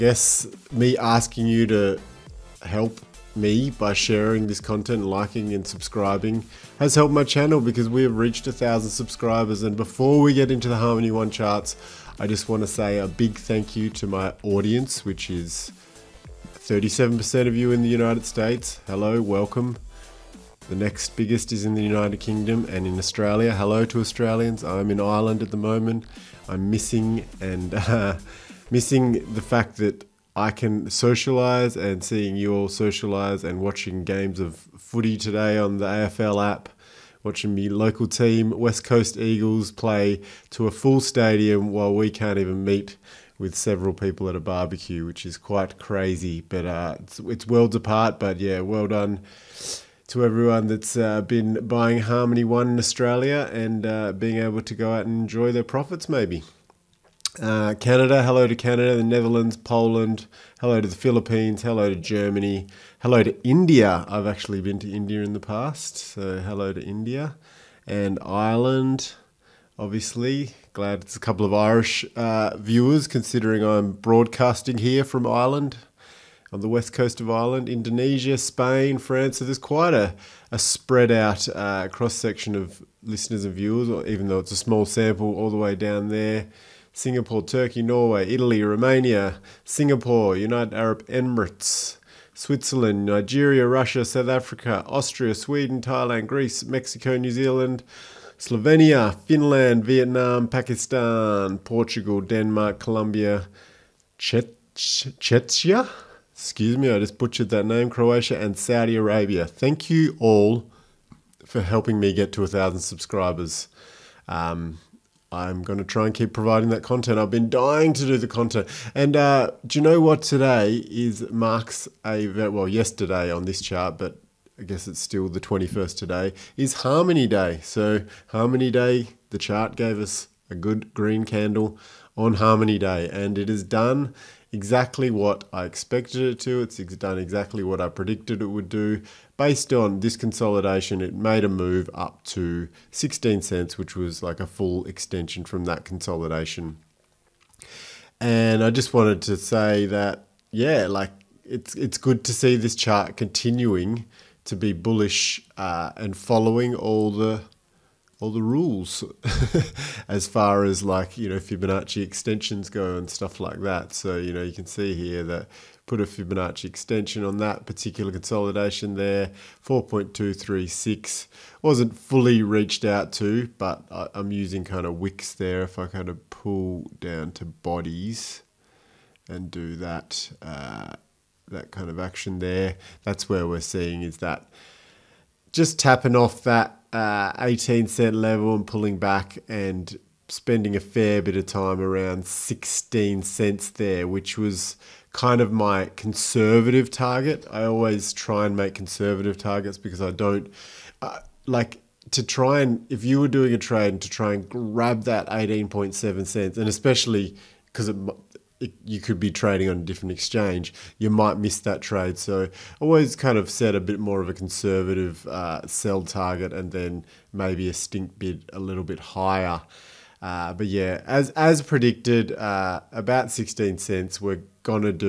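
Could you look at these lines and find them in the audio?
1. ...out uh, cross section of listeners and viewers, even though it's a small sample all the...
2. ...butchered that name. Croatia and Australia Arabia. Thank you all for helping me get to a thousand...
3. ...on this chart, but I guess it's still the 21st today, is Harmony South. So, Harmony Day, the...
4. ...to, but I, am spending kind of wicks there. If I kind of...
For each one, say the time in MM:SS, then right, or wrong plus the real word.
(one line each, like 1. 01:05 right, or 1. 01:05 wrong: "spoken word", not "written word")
1. 01:21 right
2. 01:47 wrong: "Saudi", not "Australia"
3. 02:03 wrong: "Day", not "South"
4. 02:53 wrong: "using", not "spending".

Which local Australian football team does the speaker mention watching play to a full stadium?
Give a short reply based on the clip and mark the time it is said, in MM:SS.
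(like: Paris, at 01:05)
West Coast Eagles, at 00:38.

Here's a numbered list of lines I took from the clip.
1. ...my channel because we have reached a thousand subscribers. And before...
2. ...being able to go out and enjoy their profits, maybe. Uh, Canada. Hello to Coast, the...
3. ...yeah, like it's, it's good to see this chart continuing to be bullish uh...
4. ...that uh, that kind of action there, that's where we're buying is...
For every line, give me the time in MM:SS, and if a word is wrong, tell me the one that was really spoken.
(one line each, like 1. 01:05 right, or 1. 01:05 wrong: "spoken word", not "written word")
1. 00:07 right
2. 00:54 wrong: "Canada", not "Coast"
3. 02:30 right
4. 02:59 wrong: "seeing", not "buying".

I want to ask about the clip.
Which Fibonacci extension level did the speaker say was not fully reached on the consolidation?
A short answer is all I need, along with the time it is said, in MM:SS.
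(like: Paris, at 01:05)
4.236, at 02:49.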